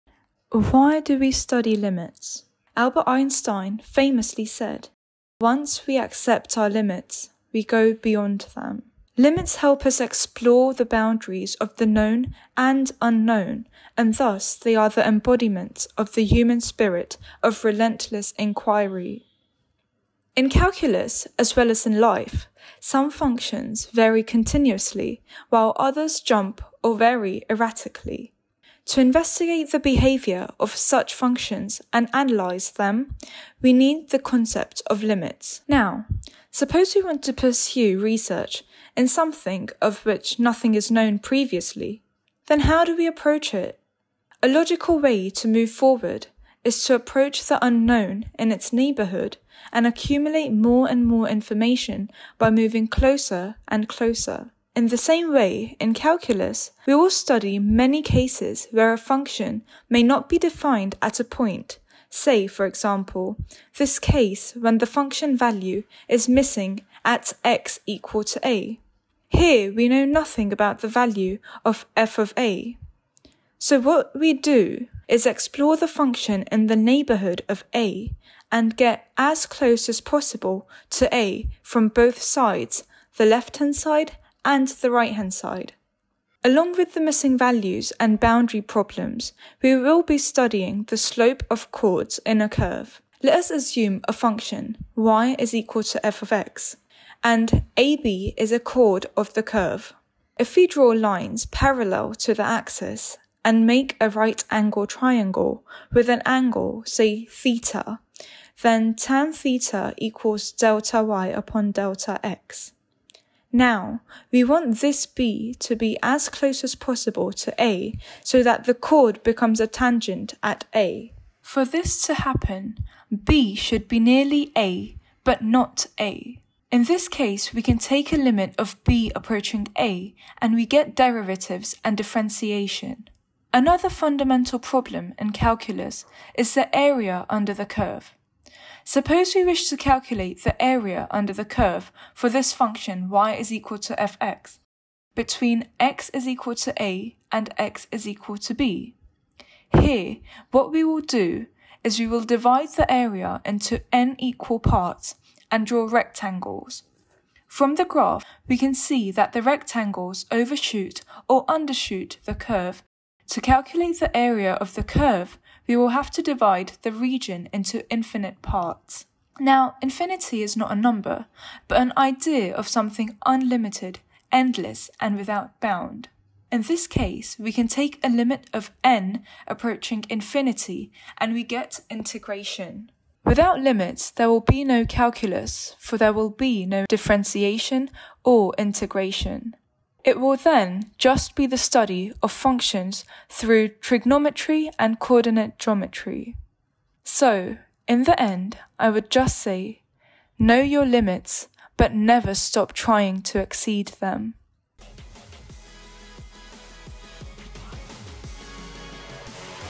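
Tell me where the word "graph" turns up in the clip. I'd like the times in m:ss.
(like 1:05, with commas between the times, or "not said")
2:37.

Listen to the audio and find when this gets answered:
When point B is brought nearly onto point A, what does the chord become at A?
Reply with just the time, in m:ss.
1:59.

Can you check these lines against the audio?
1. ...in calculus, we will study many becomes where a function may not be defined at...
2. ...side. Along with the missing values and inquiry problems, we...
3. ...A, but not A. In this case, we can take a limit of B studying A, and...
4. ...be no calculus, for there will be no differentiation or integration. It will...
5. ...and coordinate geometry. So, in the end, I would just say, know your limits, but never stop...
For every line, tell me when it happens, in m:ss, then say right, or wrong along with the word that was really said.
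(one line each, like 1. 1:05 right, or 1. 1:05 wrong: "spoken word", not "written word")
1. 0:55 wrong: "cases", not "becomes"
2. 1:25 wrong: "boundary", not "inquiry"
3. 2:04 wrong: "approaching", not "studying"
4. 3:04 right
5. 3:14 right.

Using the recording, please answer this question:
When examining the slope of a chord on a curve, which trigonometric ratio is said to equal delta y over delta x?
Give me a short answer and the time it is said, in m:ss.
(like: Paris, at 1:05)
tan theta, at 1:48.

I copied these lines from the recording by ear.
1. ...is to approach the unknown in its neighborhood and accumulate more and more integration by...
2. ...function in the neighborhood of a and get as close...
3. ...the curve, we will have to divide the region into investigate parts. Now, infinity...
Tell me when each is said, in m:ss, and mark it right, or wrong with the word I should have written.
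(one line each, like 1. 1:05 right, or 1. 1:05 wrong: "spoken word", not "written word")
1. 0:46 wrong: "information", not "integration"
2. 1:15 right
3. 2:44 wrong: "infinite", not "investigate".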